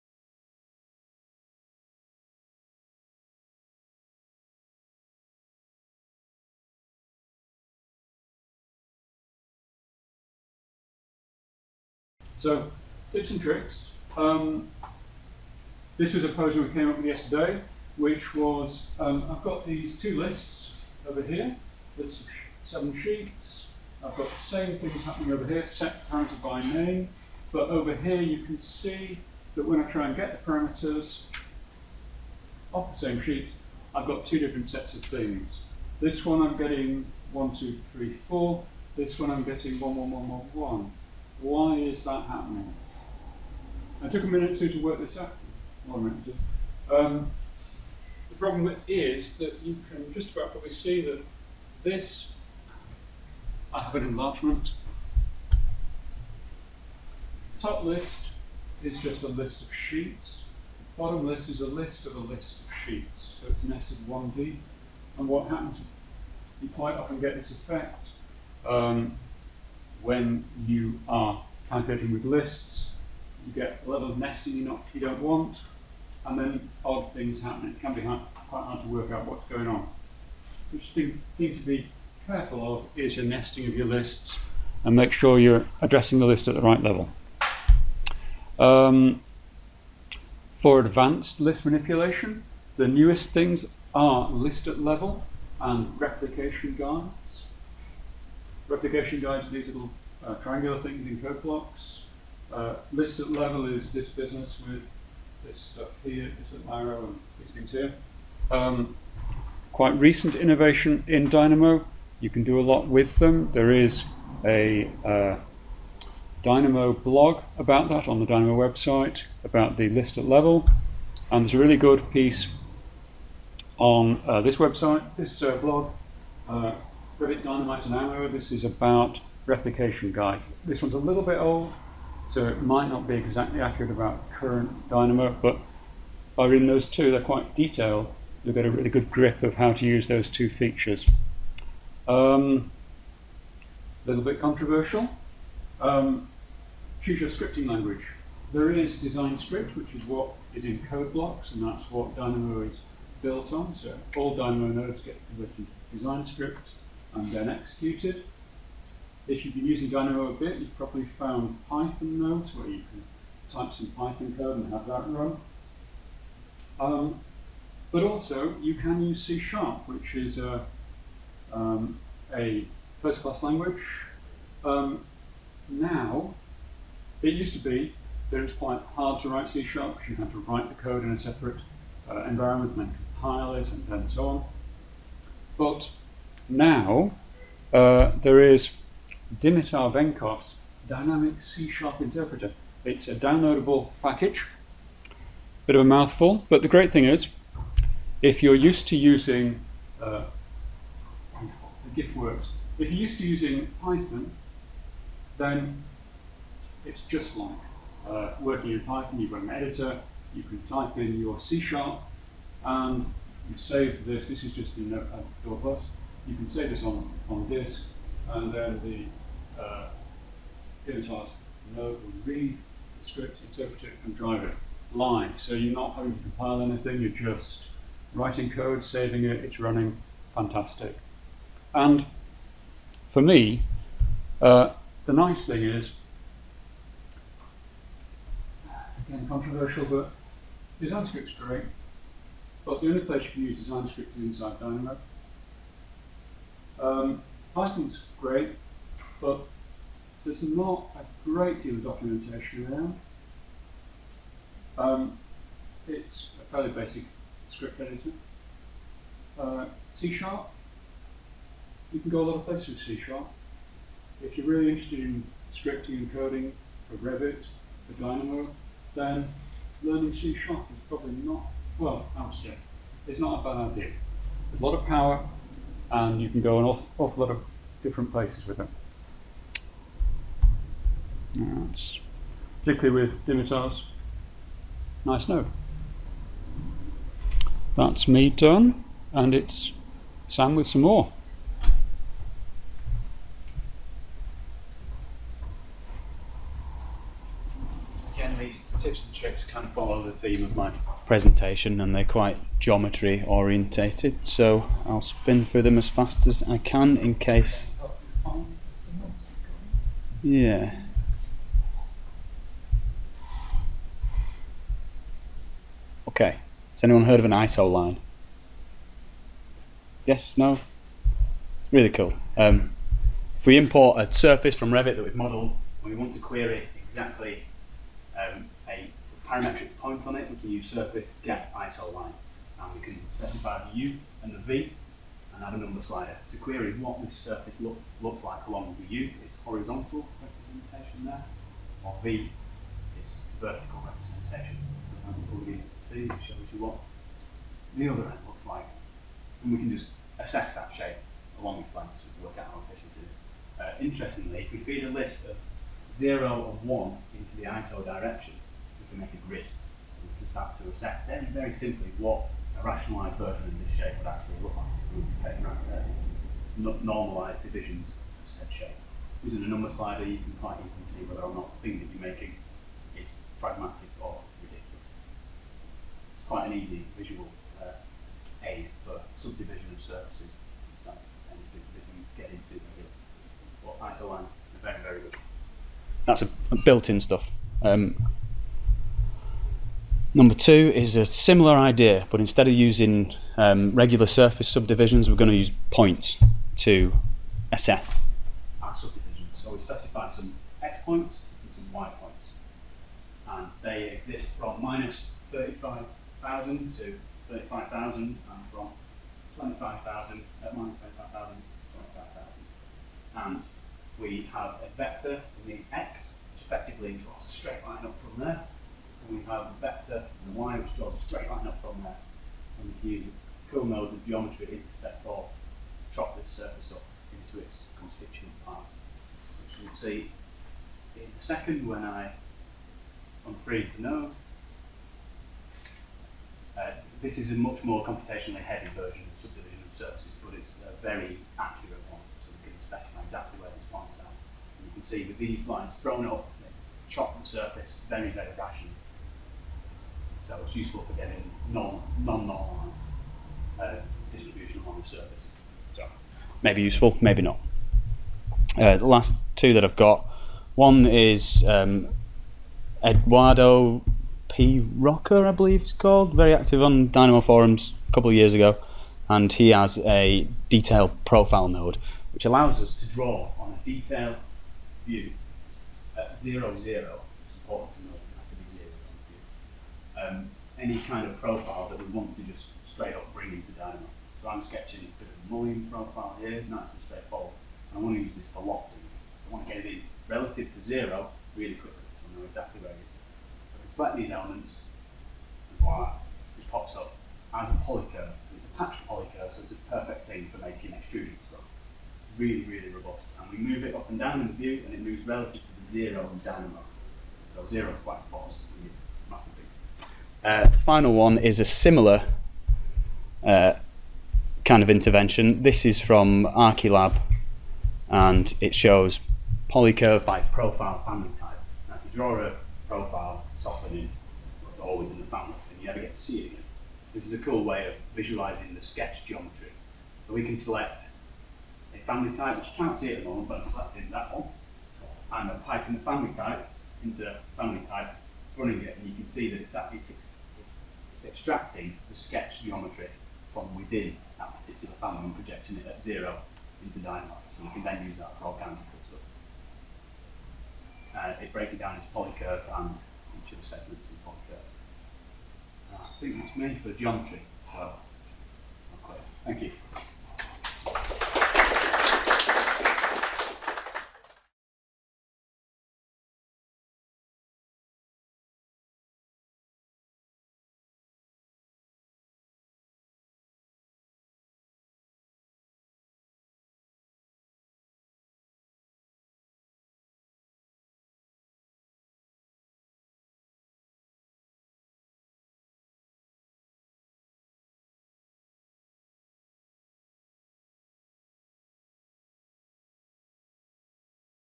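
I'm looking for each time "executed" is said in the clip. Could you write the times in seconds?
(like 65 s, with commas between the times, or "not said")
157 s.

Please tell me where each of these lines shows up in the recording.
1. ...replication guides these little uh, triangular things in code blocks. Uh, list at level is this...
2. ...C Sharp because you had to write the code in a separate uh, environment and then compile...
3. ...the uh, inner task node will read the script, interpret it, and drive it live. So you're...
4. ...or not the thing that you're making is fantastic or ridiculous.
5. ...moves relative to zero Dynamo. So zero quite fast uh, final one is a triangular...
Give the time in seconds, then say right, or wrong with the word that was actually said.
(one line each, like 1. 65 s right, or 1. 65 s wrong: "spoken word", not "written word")
1. 98 s right
2. 179 s right
3. 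218 s right
4. 371 s wrong: "pragmatic", not "fantastic"
5. 504 s wrong: "similar", not "triangular".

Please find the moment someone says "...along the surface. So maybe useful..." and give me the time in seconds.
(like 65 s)
454 s.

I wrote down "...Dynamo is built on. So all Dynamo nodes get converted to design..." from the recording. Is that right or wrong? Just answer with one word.
right.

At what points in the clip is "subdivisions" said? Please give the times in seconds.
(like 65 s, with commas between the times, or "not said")
394 s, 398 s, 439 s.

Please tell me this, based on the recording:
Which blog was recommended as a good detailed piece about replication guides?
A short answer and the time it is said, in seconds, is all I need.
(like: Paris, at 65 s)
Rivet Dynamite and Ammo, at 127 s.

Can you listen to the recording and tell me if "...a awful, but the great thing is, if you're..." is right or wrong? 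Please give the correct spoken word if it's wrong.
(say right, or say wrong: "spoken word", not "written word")
wrong: "mouthful", not "awful".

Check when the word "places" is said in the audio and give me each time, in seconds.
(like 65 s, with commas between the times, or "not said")
243 s, 262 s, 278 s.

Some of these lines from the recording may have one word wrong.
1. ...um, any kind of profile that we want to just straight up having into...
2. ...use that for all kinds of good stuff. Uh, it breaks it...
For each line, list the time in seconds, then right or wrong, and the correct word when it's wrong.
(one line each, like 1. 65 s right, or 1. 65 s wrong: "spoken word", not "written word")
1. 480 s wrong: "bring", not "having"
2. 547 s right.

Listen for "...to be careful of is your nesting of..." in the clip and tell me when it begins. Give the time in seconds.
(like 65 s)
81 s.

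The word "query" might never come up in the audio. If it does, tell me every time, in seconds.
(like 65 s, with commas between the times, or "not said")
326 s, 336 s.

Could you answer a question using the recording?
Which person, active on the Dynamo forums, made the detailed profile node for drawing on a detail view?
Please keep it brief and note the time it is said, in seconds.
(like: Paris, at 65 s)
Eduardo P. Rocker, at 462 s.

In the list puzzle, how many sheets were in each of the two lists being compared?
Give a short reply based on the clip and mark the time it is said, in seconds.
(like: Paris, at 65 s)
7, at 22 s.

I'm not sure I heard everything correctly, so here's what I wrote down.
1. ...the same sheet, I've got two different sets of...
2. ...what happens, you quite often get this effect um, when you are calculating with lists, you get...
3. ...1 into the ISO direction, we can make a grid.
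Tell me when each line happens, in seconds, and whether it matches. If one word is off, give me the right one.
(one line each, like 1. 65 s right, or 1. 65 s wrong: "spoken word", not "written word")
1. 32 s right
2. 65 s right
3. 356 s right.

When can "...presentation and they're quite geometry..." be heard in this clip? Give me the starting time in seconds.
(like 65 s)
301 s.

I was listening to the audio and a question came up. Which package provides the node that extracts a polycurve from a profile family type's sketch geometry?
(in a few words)
Archilab.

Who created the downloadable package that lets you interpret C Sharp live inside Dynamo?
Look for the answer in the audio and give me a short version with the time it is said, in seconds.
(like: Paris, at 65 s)
Dimitar Venkov, at 189 s.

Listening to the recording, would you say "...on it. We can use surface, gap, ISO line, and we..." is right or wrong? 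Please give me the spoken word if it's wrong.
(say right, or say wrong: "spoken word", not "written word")
right.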